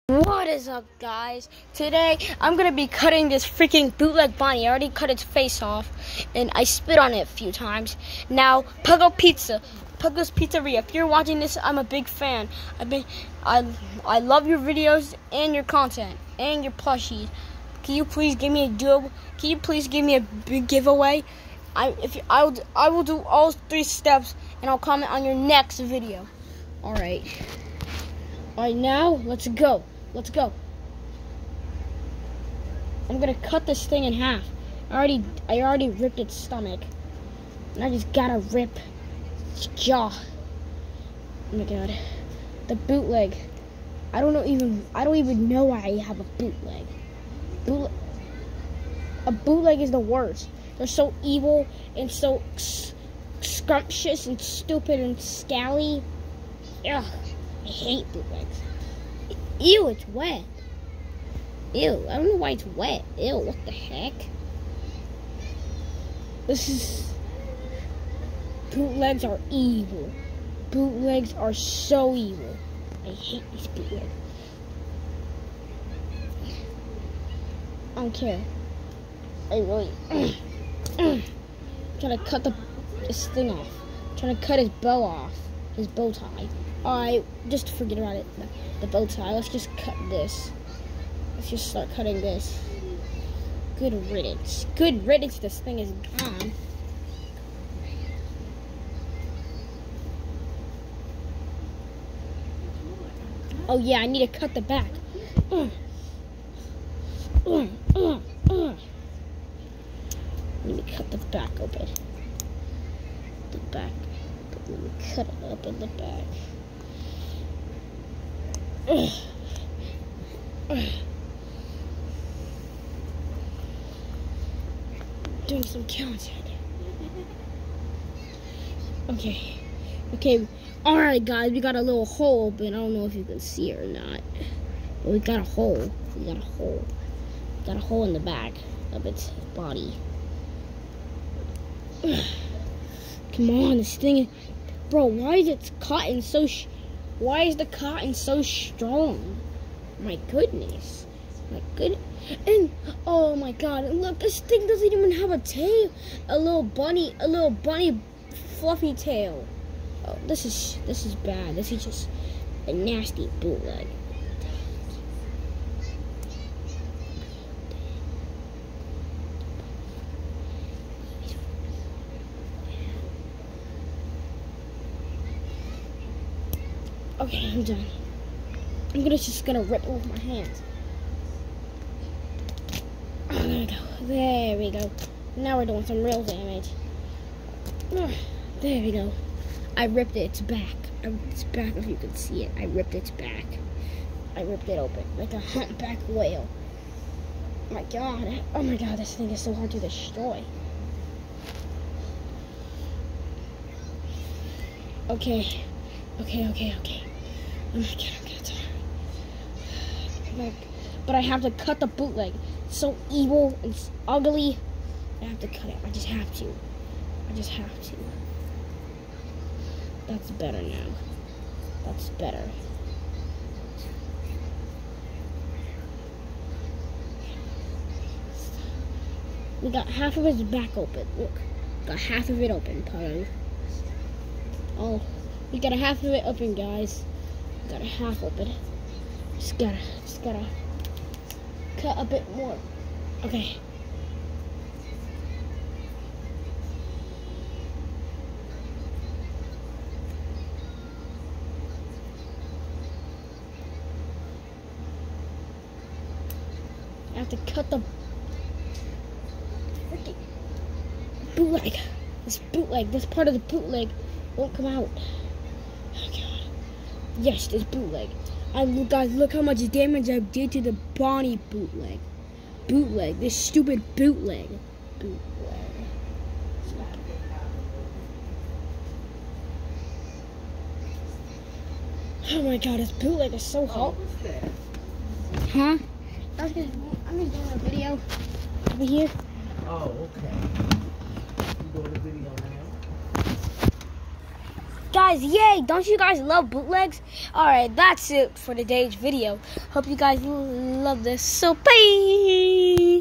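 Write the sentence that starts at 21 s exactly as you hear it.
I, if you, I will, I will do all three steps, and I'll comment on your next video.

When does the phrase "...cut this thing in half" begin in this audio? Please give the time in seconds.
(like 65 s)
33 s.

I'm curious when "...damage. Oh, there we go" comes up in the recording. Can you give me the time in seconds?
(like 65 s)
186 s.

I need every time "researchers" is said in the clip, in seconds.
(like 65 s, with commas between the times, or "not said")
not said.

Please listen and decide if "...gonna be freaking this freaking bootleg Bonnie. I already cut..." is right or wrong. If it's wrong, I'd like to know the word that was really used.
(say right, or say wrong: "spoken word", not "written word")
wrong: "cutting", not "freaking".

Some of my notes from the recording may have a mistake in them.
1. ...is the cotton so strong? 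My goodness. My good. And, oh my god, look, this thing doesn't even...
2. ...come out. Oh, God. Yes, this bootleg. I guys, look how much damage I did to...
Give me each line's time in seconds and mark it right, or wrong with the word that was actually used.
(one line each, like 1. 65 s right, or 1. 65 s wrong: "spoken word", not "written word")
1. 147 s right
2. 264 s right.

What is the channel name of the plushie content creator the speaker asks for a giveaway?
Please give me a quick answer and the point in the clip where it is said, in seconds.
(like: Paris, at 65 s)
Puggo's Pizzeria, at 9 s.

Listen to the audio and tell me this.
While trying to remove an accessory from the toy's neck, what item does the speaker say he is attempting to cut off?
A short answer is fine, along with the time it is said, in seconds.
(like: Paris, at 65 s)
His bow tie, at 85 s.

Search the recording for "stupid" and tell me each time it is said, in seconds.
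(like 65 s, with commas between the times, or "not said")
54 s, 273 s.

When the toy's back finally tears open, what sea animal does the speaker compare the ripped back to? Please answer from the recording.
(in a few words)
humpback whale.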